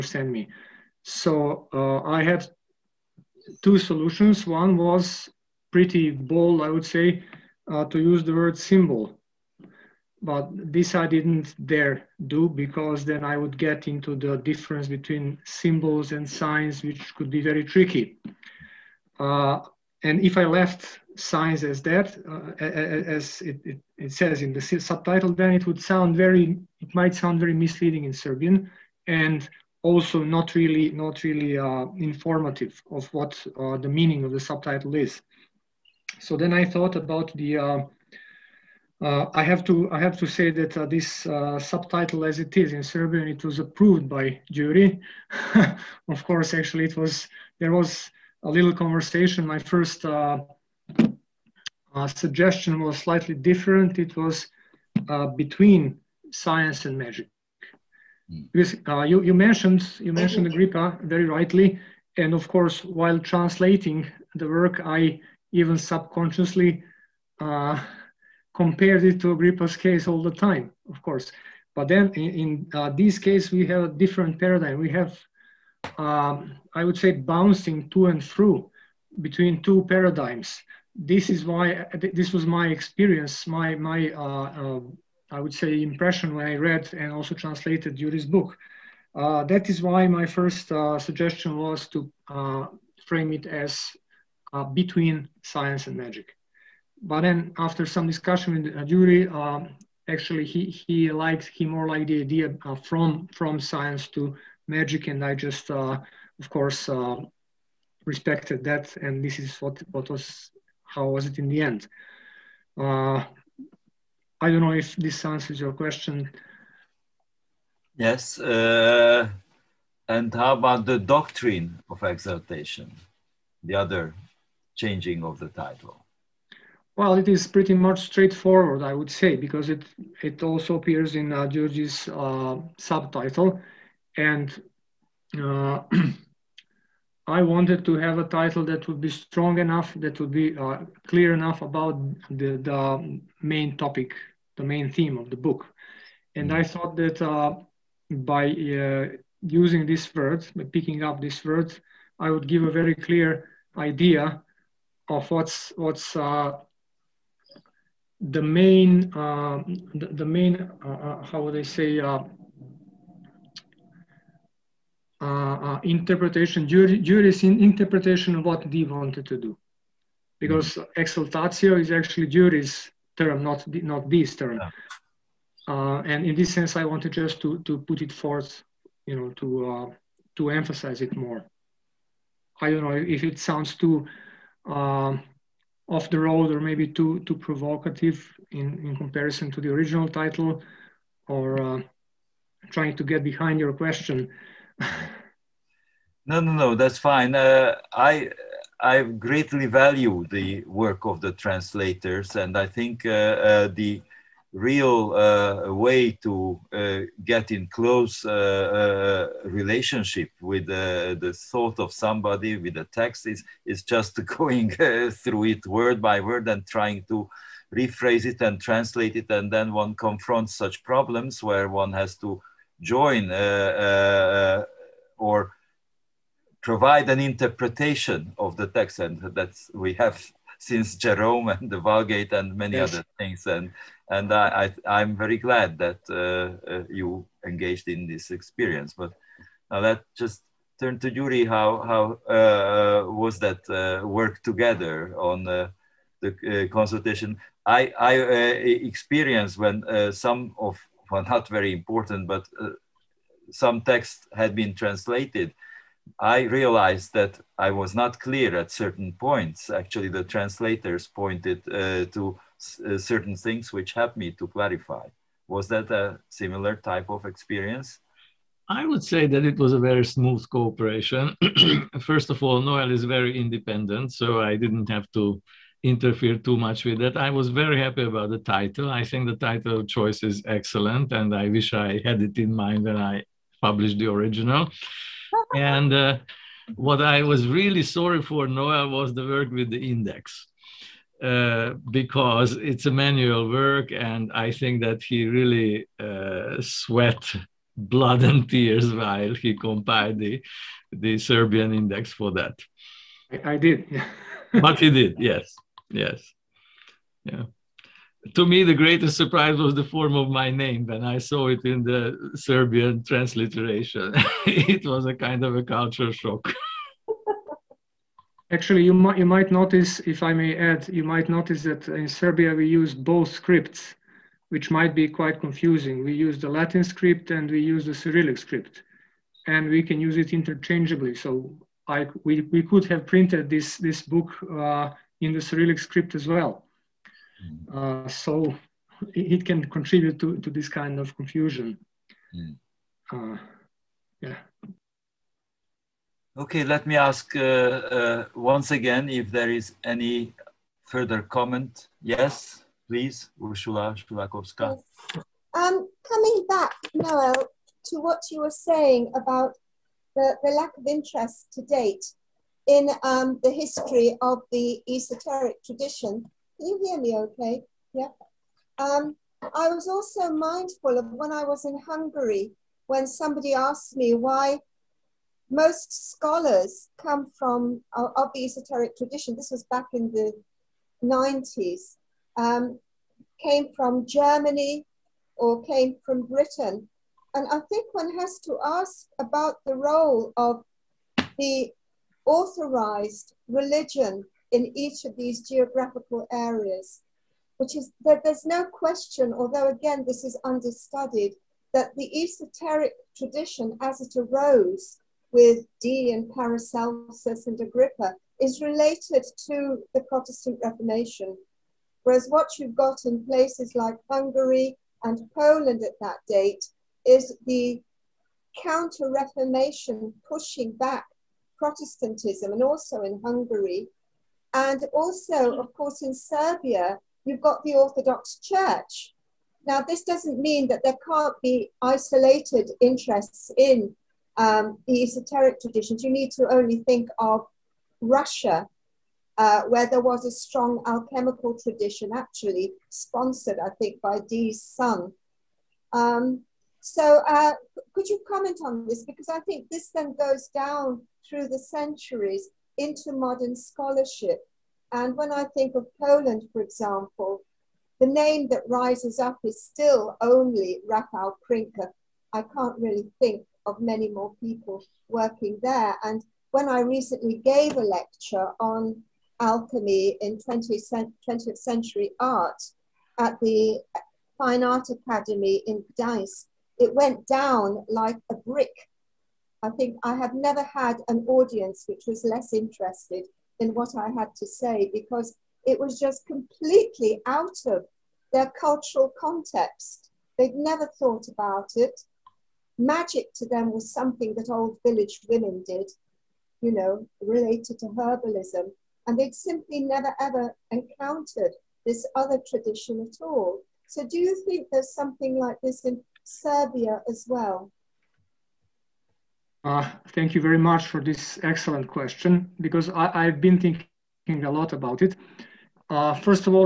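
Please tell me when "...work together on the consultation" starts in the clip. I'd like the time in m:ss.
4:04.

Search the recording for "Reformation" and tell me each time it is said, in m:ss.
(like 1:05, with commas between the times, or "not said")
6:50, 6:59.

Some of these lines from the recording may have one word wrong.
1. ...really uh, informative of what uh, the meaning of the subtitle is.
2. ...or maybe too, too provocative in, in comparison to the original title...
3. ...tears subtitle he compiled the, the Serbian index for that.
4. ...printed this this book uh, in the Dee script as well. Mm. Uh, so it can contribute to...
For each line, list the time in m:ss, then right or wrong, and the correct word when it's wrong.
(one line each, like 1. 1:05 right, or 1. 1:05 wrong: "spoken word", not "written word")
1. 0:31 right
2. 3:06 right
3. 4:58 wrong: "while", not "subtitle"
4. 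5:33 wrong: "Cyrillic", not "Dee".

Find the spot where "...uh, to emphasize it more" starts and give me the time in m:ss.
2:59.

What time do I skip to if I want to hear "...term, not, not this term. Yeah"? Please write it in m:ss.
2:53.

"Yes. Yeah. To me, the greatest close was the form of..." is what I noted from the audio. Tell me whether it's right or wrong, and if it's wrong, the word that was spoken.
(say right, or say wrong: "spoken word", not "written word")
wrong: "surprise", not "close".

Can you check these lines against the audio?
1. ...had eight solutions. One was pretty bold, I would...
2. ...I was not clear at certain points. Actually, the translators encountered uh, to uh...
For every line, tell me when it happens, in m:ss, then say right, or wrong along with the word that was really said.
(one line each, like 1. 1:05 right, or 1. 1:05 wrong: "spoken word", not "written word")
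1. 0:02 wrong: "two", not "eight"
2. 4:17 wrong: "pointed", not "encountered".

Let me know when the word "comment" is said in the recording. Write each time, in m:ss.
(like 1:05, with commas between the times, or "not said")
5:51, 7:28.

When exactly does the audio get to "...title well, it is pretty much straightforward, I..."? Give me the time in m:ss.
2:05.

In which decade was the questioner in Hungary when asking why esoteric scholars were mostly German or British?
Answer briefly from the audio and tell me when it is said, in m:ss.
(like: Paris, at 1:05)
1990s, at 6:20.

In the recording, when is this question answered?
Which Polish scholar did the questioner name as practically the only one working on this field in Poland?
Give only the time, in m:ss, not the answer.
7:40.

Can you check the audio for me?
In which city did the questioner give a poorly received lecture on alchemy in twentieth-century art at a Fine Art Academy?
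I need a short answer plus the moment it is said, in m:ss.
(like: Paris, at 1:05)
Gdańsk, at 7:55.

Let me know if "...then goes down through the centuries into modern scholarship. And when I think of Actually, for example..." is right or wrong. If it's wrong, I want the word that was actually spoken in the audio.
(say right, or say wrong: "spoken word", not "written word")
wrong: "Poland", not "Actually".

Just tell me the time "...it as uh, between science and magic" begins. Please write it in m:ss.
1:33.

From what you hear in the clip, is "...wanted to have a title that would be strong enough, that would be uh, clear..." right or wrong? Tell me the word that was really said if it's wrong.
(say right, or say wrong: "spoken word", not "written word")
right.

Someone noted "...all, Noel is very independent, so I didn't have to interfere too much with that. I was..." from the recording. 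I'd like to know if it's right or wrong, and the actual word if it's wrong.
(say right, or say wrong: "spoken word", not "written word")
right.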